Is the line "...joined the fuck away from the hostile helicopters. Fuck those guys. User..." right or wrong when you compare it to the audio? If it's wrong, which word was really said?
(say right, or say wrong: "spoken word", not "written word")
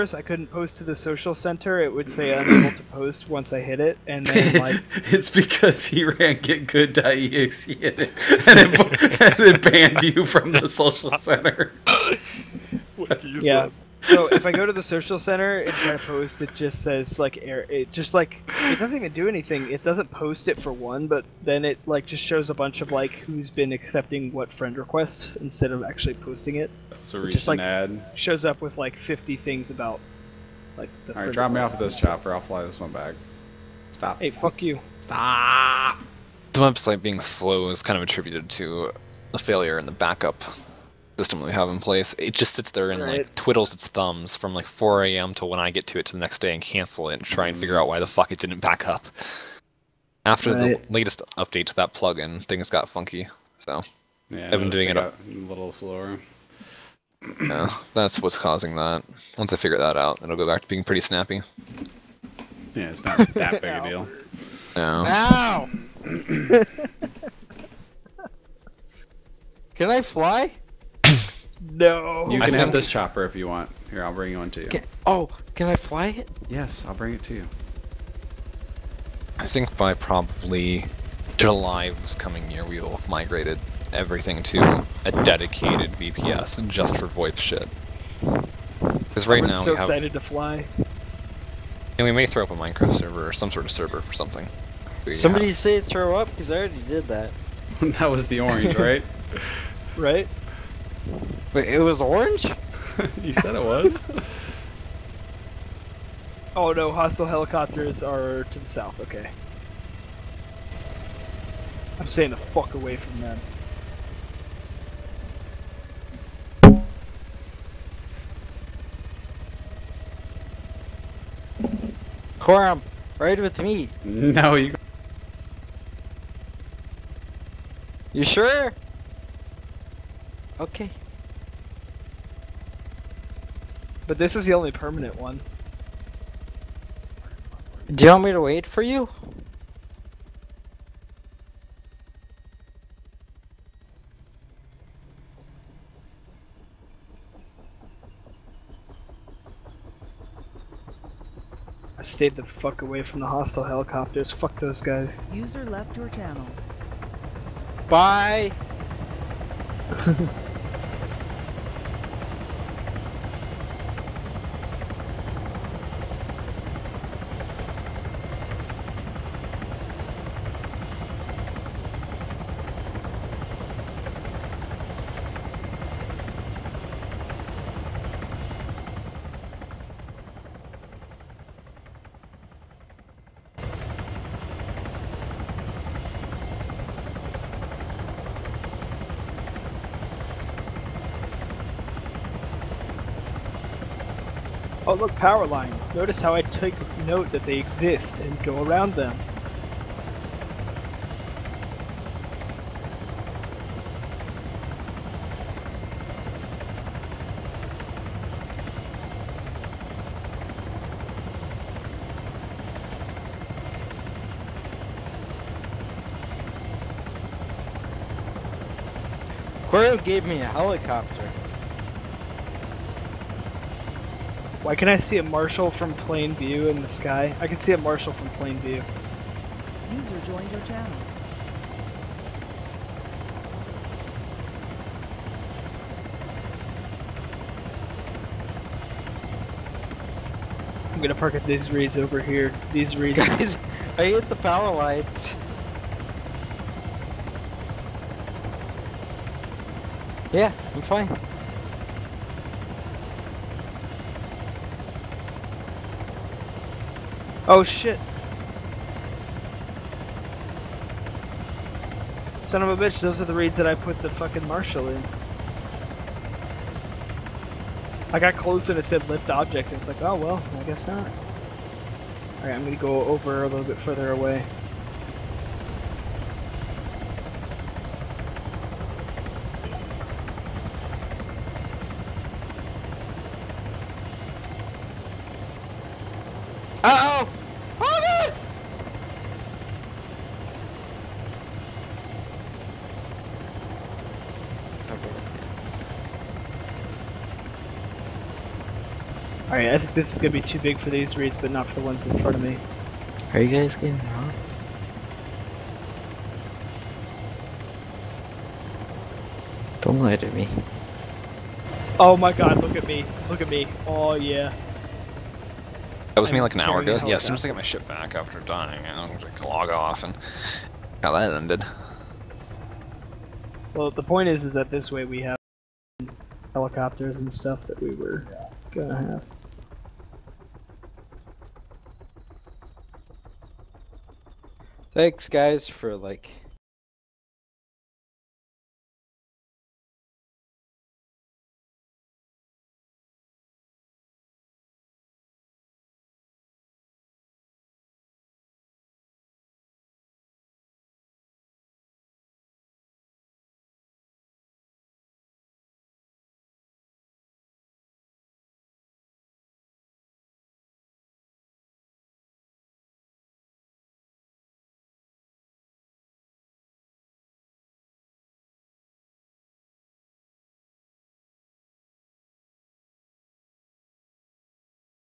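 wrong: "stayed", not "joined".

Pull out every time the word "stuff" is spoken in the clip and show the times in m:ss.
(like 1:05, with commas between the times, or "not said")
5:27.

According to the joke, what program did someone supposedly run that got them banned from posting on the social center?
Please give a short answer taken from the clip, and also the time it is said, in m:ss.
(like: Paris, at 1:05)
getgood.exe, at 0:06.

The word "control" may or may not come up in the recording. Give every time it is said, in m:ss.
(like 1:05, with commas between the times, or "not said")
not said.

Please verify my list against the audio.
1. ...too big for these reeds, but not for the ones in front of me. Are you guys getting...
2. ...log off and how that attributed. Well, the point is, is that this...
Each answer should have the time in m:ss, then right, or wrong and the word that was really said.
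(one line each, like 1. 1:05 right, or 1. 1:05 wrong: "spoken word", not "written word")
1. 5:00 right
2. 5:19 wrong: "ended", not "attributed".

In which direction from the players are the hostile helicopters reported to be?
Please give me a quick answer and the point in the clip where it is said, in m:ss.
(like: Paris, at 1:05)
south, at 1:48.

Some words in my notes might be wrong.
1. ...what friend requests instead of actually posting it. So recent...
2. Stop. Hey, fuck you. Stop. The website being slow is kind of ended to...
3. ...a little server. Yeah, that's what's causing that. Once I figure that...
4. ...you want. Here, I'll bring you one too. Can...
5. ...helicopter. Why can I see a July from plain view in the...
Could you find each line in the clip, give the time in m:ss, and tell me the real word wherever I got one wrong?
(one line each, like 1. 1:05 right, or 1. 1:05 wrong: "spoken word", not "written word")
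1. 0:24 right
2. 0:33 wrong: "attributed", not "ended"
3. 0:54 wrong: "slower", not "server"
4. 1:13 right
5. 3:40 wrong: "Marshall", not "July".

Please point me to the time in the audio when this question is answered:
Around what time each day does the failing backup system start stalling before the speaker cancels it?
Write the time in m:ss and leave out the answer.
0:44.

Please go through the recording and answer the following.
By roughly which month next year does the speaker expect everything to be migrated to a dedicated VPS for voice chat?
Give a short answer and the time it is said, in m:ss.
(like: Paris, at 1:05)
July, at 1:21.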